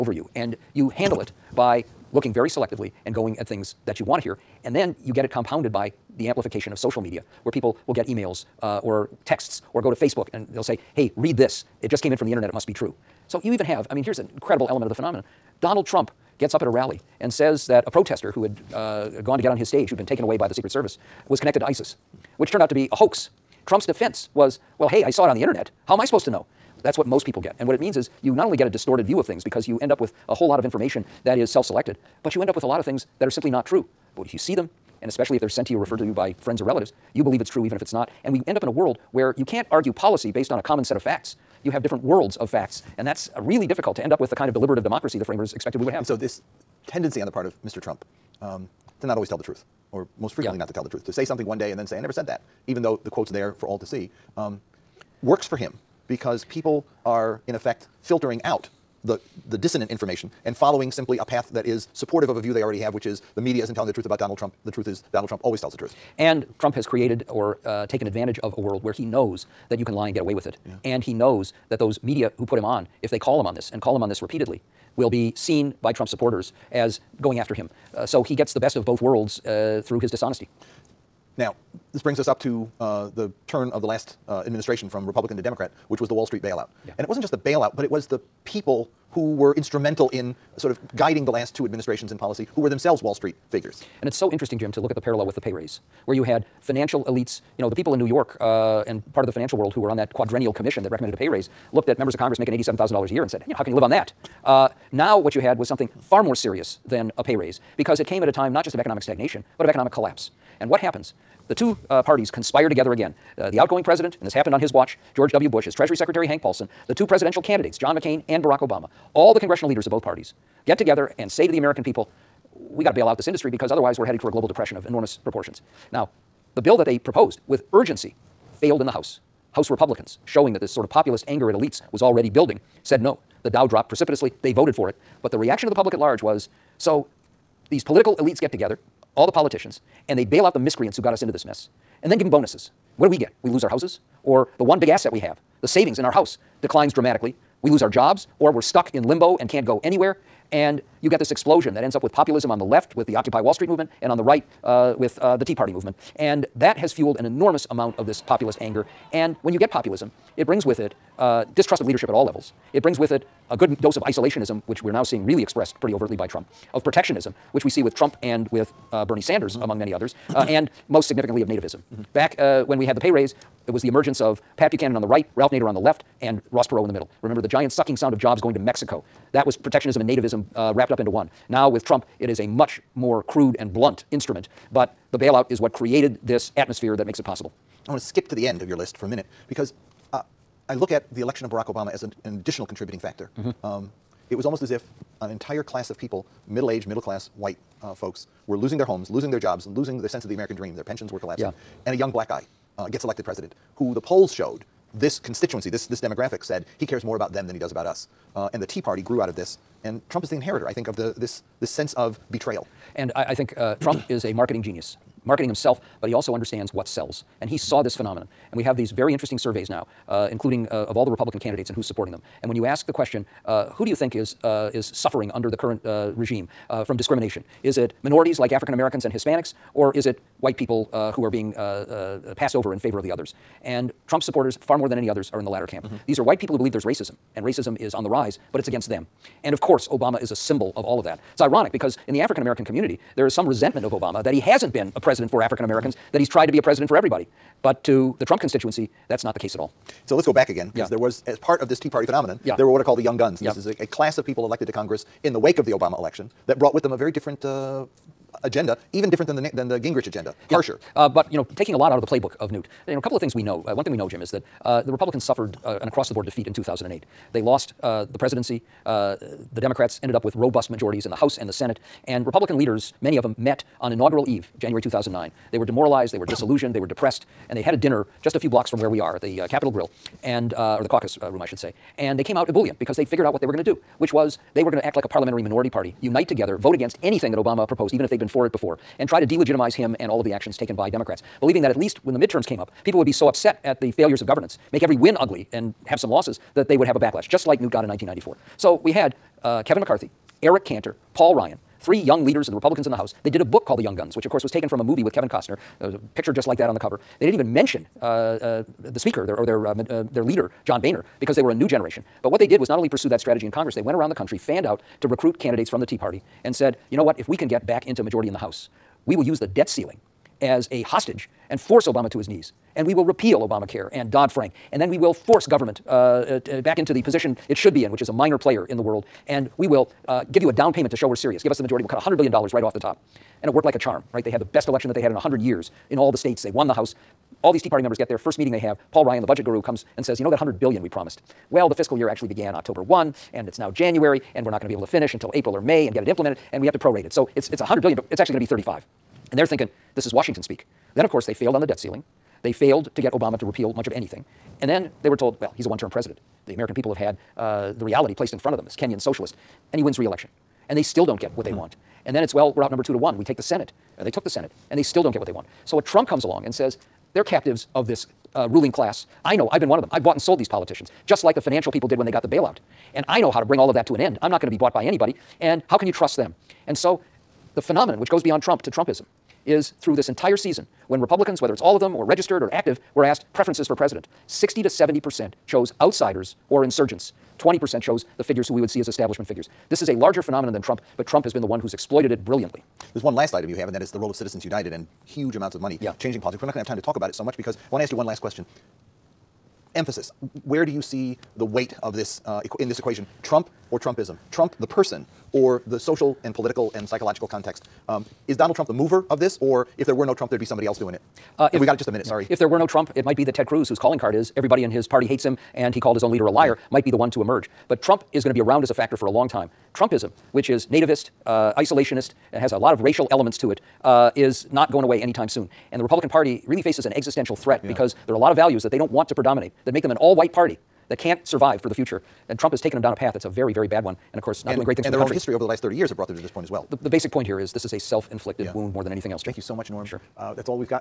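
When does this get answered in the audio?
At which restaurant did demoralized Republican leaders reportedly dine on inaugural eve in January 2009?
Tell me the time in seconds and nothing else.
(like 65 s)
279 s.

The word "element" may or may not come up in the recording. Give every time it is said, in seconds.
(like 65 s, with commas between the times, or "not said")
14 s, 423 s.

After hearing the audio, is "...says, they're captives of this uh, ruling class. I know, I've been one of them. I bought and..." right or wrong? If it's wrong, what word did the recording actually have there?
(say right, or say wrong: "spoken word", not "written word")
right.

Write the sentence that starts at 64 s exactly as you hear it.
The truth is Donald Trump always tells the truth.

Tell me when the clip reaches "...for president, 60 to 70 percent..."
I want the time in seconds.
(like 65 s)
383 s.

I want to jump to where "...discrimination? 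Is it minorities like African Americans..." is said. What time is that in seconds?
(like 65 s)
226 s.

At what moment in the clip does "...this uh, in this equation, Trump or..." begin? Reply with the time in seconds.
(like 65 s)
401 s.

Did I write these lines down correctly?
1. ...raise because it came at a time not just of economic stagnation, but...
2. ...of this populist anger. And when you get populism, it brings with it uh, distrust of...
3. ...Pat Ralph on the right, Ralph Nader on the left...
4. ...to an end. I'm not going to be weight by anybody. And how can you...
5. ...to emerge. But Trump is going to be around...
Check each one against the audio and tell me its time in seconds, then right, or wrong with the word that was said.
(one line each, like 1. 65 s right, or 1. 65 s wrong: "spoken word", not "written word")
1. 107 s right
2. 157 s right
3. 174 s wrong: "Buchanan", not "Ralph"
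4. 373 s wrong: "bought", not "weight"
5. 417 s right.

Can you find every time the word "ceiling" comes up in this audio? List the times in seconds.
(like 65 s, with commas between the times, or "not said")
319 s, 351 s.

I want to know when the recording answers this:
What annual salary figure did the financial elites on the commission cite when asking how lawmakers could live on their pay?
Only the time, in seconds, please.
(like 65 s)
102 s.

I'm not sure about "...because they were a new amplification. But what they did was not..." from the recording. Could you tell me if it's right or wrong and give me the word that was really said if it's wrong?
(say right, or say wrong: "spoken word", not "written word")
wrong: "generation", not "amplification".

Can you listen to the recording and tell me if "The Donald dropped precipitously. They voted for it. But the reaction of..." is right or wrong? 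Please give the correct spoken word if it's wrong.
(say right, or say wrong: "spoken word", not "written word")
wrong: "Dow", not "Donald".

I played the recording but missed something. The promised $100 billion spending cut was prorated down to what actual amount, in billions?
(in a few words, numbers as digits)
35.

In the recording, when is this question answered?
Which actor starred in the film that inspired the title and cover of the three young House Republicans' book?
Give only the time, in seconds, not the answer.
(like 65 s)
305 s.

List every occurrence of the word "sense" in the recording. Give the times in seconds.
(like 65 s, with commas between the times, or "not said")
200 s, 211 s.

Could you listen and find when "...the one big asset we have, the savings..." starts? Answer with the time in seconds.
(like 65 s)
144 s.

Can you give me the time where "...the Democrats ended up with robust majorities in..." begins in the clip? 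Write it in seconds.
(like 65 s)
269 s.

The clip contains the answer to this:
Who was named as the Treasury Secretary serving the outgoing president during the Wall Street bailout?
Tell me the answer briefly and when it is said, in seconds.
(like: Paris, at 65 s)
Hank Paulson, at 116 s.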